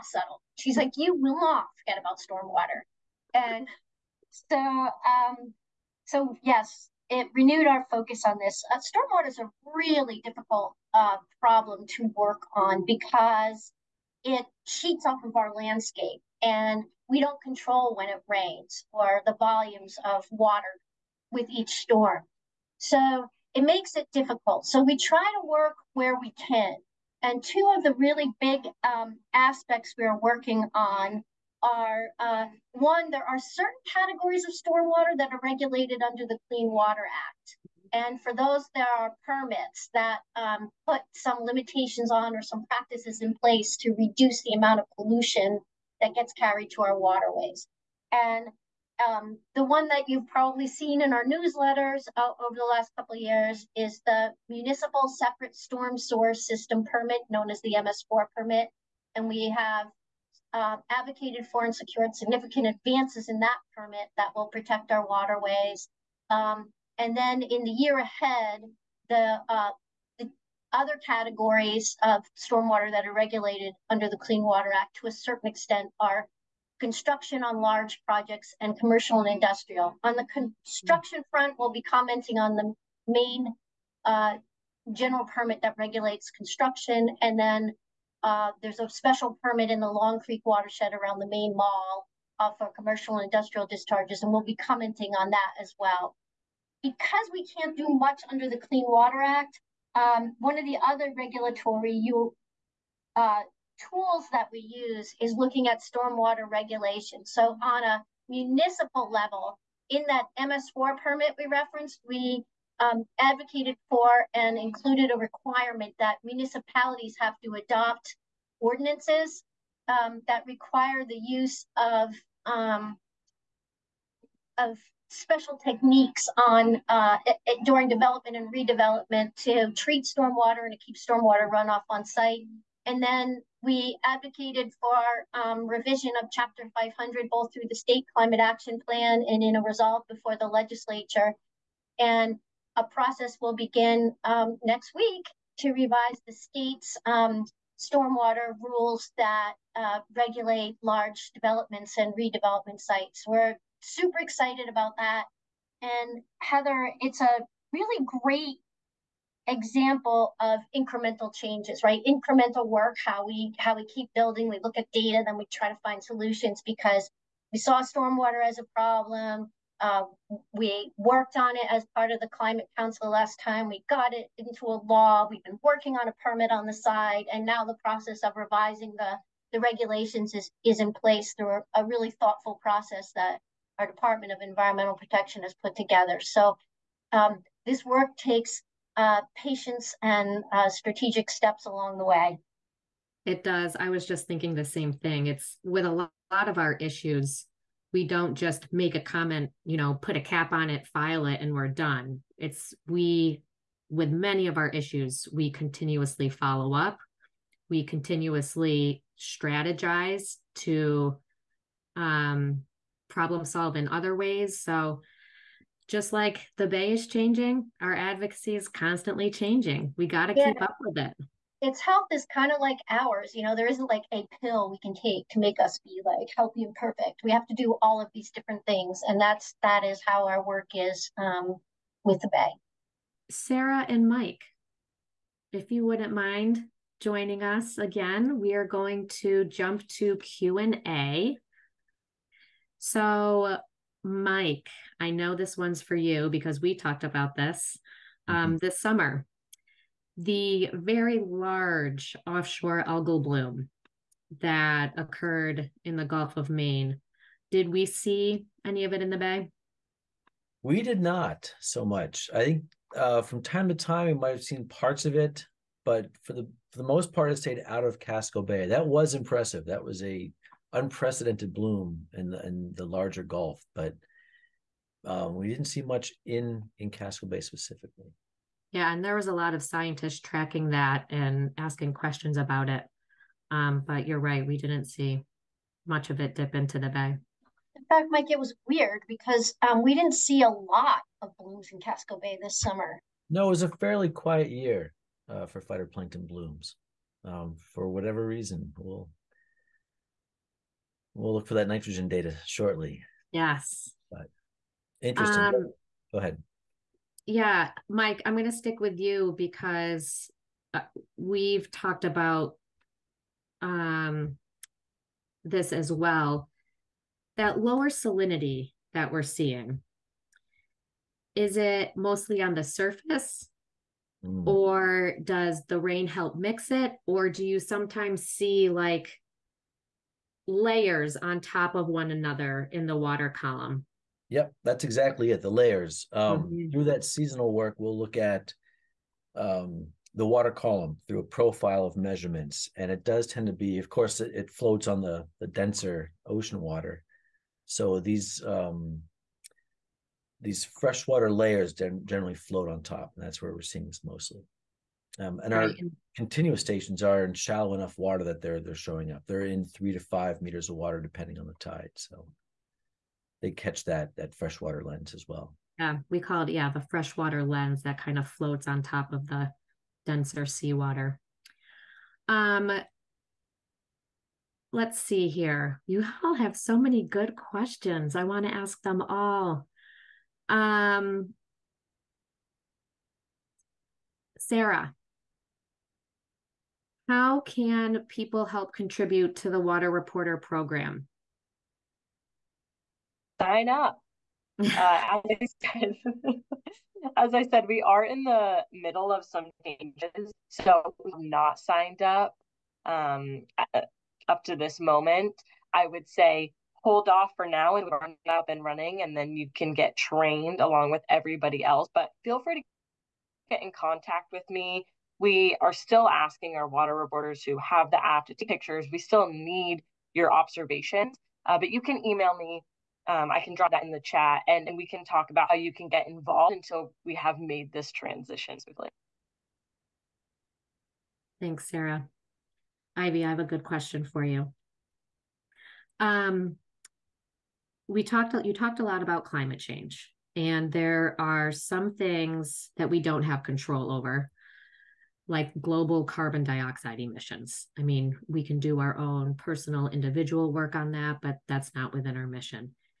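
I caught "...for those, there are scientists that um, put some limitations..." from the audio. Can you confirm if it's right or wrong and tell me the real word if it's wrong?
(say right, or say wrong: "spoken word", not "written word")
wrong: "permits", not "scientists".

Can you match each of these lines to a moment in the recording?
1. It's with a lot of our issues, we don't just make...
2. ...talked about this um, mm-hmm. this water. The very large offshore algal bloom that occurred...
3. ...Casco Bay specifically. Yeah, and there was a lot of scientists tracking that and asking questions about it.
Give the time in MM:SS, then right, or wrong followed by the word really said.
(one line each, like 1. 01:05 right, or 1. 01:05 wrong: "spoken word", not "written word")
1. 03:15 right
2. 04:06 wrong: "summer", not "water"
3. 04:36 right.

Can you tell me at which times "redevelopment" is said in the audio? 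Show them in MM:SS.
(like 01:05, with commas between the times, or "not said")
02:08, 02:32.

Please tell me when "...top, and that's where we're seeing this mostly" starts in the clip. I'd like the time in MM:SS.
05:52.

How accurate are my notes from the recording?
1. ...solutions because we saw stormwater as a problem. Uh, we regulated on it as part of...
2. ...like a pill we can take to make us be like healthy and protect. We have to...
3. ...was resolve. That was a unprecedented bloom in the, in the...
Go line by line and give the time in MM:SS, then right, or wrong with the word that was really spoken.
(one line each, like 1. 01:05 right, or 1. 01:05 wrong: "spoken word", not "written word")
1. 02:46 wrong: "worked", not "regulated"
2. 03:43 wrong: "perfect", not "protect"
3. 04:28 wrong: "impressive", not "resolve".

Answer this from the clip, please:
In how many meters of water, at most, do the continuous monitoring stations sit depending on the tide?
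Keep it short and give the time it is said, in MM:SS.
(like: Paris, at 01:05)
5 meters, at 05:59.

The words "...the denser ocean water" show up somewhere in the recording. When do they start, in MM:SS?
05:45.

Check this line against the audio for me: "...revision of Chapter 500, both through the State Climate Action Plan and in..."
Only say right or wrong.
right.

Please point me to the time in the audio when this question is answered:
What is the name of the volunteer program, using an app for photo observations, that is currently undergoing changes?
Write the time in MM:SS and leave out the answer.
06:29.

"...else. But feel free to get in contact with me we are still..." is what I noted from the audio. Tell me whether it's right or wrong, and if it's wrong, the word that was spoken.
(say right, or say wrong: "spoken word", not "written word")
right.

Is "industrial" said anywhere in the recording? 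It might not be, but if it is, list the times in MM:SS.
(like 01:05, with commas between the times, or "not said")
01:19, 01:33.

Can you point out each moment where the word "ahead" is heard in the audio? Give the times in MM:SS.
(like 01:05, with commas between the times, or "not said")
01:07, 05:06.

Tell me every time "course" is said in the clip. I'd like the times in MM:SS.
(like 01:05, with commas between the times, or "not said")
05:43.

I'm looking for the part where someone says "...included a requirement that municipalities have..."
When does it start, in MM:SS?
01:54.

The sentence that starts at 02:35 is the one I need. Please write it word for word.
And Heather, it's a really great example of incremental changes, right?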